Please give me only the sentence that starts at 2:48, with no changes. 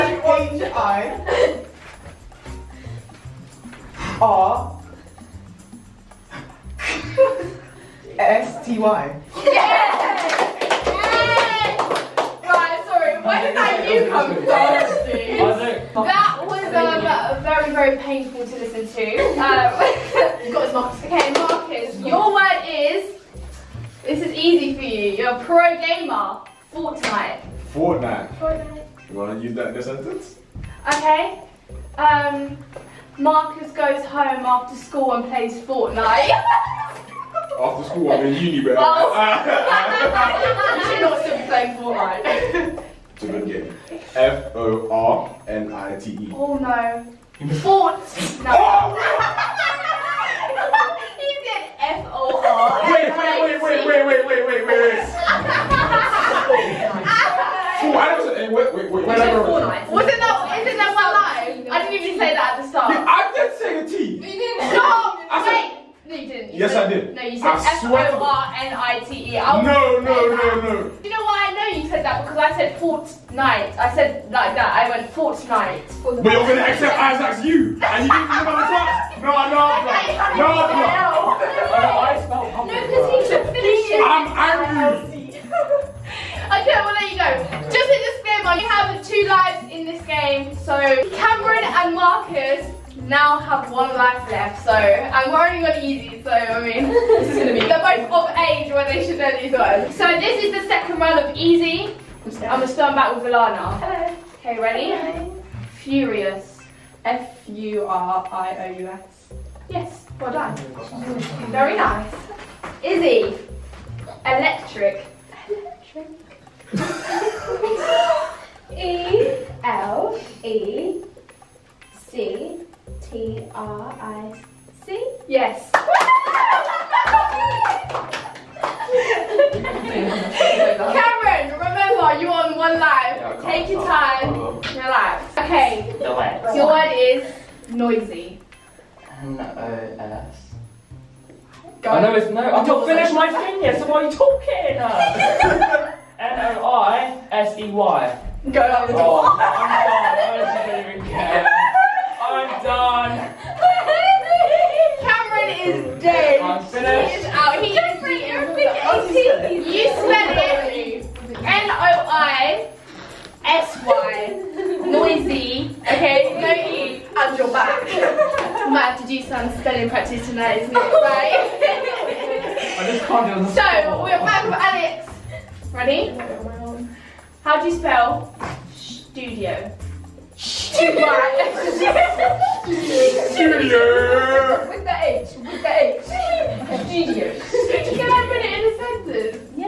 Might have to do some spelling practice tonight, isn't it, right?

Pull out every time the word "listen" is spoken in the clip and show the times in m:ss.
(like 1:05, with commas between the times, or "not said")
0:18.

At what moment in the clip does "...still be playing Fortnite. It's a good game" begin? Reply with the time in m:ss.
0:41.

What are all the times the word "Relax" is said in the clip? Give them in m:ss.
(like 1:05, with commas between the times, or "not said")
2:14.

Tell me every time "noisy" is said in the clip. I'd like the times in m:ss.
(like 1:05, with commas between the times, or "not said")
2:17, 2:44.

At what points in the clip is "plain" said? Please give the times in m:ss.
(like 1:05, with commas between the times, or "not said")
not said.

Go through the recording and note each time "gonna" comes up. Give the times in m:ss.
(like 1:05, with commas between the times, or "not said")
1:16, 1:37, 1:42.